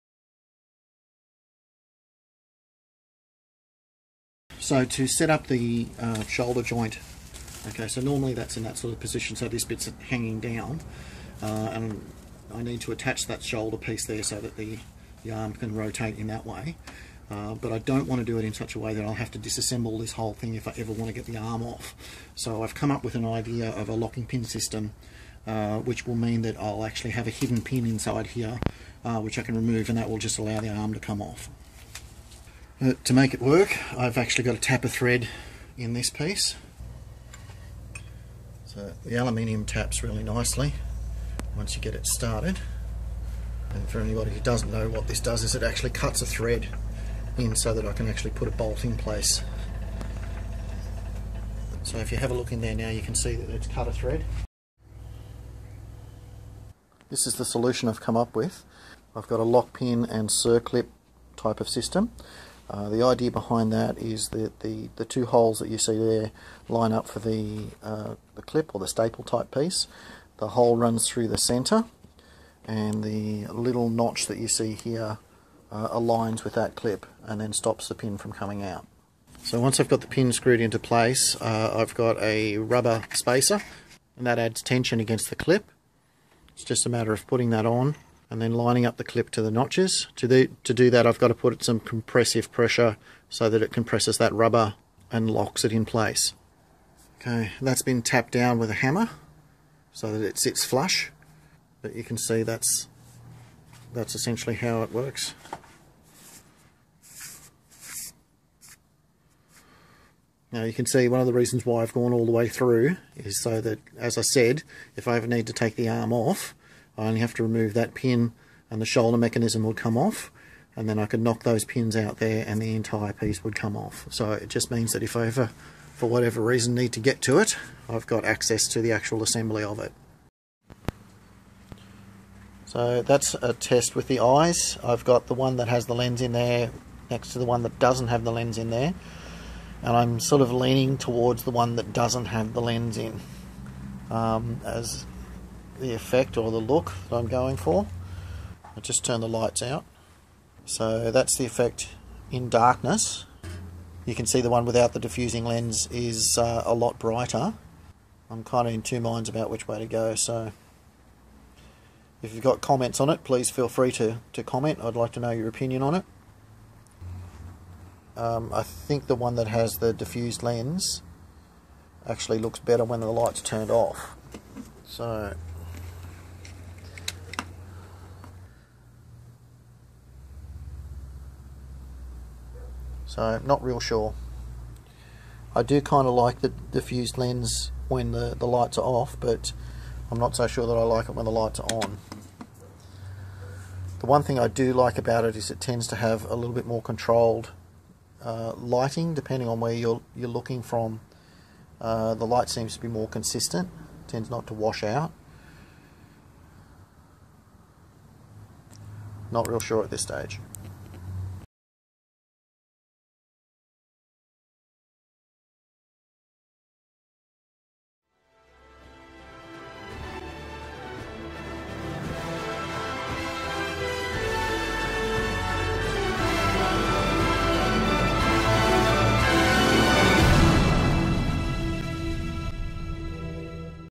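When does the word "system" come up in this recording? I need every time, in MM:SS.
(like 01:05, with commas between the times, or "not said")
00:24, 01:01.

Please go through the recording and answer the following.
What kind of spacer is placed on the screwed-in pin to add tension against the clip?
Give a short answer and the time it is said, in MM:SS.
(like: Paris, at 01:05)
rubber spacer, at 01:22.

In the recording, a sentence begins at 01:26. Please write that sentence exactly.
It's just a matter of putting that on and then lining up the clip to the notches.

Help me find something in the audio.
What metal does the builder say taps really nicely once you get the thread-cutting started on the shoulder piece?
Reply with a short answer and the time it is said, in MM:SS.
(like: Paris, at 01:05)
aluminium, at 00:39.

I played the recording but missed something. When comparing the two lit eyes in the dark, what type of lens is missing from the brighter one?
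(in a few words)
diffusing lens.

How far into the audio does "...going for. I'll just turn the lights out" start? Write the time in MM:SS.
02:27.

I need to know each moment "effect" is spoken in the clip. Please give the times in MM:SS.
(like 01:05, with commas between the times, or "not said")
02:25, 02:31.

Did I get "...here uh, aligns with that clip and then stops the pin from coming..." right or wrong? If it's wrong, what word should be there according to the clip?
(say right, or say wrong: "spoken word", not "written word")
right.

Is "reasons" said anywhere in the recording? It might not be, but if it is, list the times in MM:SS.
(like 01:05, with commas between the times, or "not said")
01:51, 02:06.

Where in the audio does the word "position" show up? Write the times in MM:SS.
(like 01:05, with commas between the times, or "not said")
00:08.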